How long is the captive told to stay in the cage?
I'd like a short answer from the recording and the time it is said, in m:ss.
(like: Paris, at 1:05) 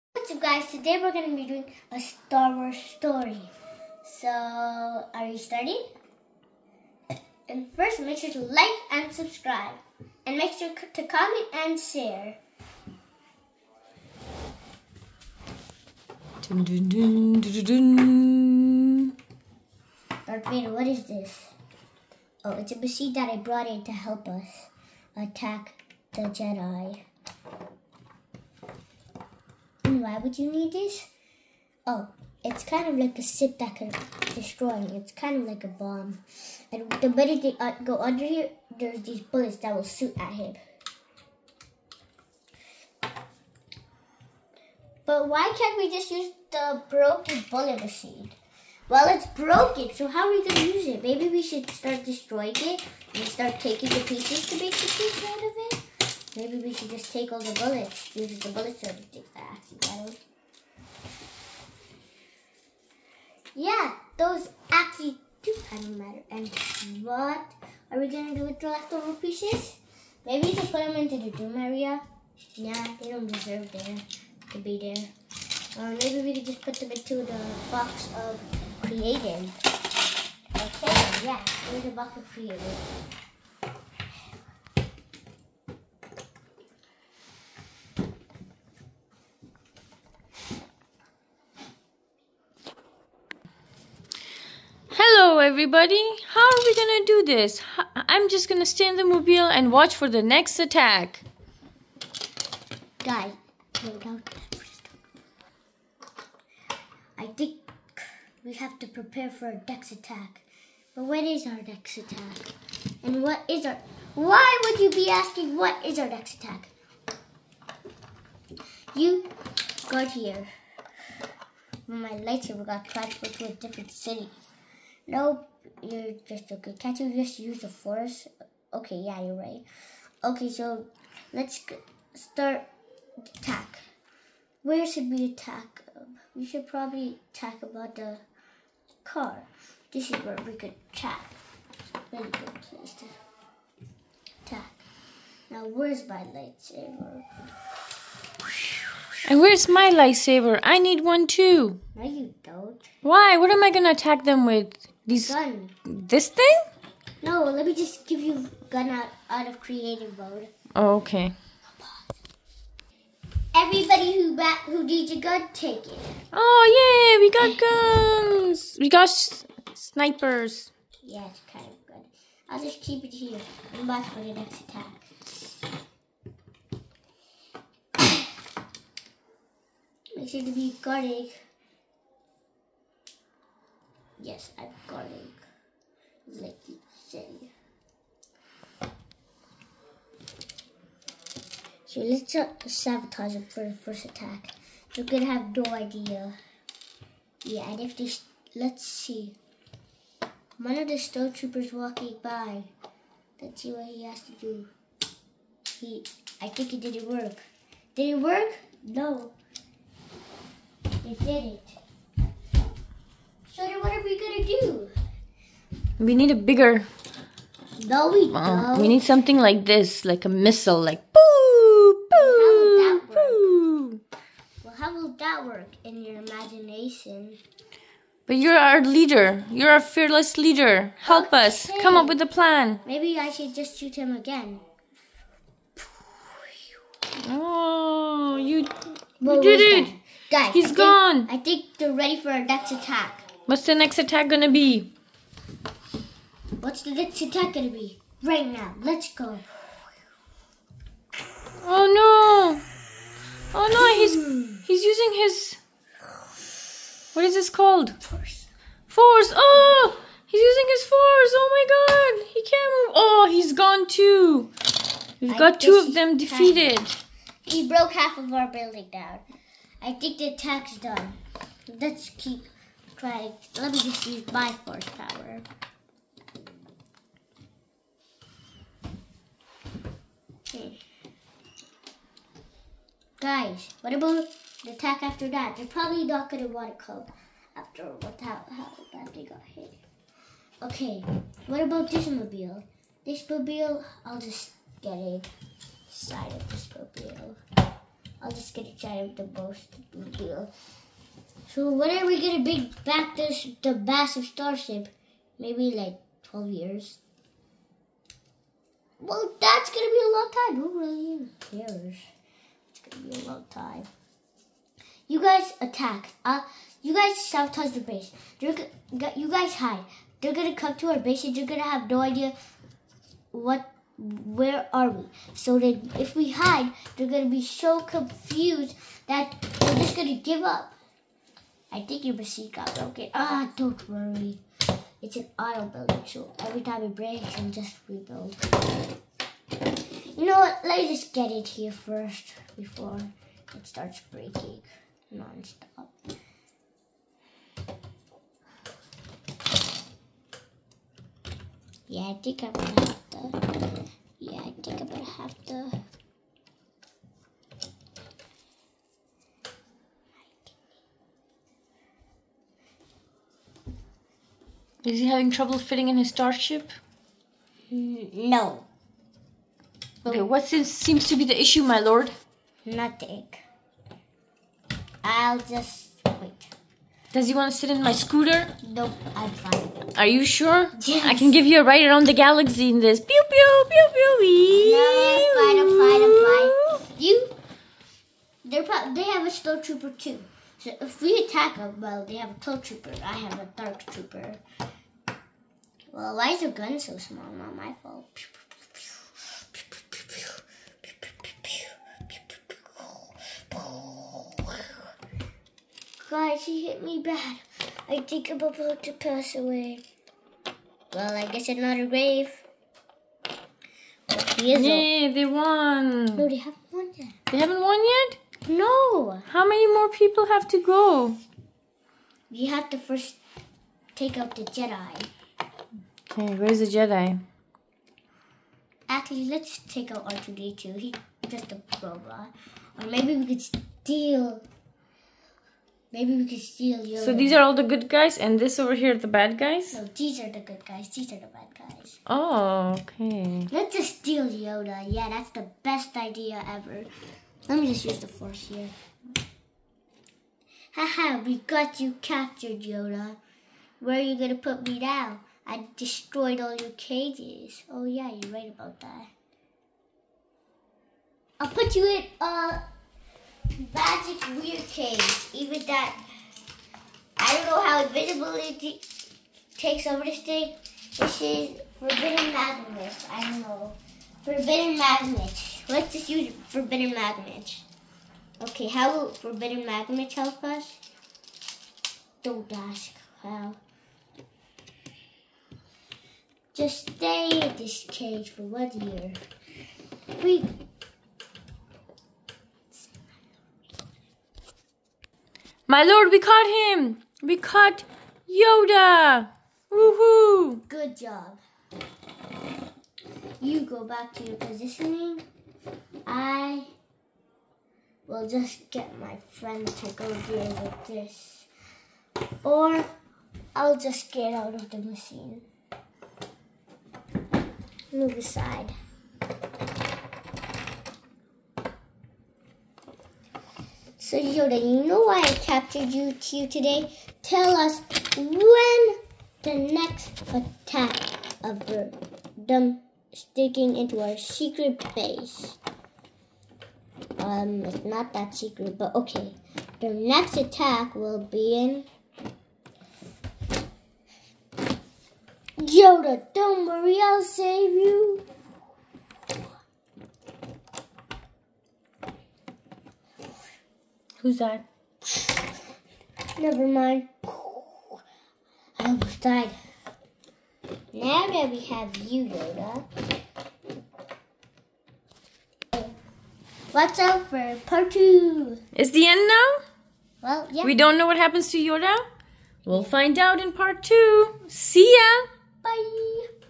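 1 year, at 8:08.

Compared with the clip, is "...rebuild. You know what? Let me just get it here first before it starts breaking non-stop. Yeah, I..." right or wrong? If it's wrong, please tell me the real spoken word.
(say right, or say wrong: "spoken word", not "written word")
right.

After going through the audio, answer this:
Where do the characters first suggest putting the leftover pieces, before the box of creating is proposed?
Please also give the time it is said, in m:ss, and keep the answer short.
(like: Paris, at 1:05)
the doom area, at 1:11.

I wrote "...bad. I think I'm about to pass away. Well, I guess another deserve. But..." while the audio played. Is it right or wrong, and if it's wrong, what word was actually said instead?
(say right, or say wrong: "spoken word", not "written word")
wrong: "grave", not "deserve".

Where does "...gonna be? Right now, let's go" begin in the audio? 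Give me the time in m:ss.
4:07.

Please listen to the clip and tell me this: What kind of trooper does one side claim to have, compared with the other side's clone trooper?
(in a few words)
dark trooper.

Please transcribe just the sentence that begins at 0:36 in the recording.
And the minute they uh, go under here, there's these bullets that will shoot at him.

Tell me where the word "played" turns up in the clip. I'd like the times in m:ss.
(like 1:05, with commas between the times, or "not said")
not said.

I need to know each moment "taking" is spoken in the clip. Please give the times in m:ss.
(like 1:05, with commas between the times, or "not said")
0:53.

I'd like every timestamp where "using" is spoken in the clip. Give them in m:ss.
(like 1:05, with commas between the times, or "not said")
4:14, 4:20.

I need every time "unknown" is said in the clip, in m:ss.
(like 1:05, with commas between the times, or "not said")
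not said.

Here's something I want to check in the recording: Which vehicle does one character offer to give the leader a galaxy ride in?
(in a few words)
scooter.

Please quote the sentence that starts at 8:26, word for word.
I will just get my friend to go deal with this.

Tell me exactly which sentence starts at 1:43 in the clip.
Guys, I think we have to prepare for a Dex attack.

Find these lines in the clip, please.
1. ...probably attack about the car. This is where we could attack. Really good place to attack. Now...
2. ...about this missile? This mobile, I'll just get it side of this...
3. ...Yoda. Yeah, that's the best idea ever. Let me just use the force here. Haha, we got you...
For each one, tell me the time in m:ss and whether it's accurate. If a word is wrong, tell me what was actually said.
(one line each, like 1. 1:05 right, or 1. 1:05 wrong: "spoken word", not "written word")
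1. 2:16 right
2. 4:51 wrong: "mobile", not "missile"
3. 7:24 right.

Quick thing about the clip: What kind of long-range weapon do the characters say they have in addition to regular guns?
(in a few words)
snipers.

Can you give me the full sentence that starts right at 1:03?
Yeah, those actually do kind of matter.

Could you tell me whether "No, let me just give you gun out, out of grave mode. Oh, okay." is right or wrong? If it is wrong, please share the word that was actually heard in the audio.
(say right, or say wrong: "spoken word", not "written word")
wrong: "creative", not "grave".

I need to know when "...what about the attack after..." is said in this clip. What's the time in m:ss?
4:43.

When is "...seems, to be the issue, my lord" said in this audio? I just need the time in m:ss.
6:10.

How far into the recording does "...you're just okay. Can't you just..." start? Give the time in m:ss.
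2:05.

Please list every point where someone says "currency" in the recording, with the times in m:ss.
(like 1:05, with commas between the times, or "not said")
not said.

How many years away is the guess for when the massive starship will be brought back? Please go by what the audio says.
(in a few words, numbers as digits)
12.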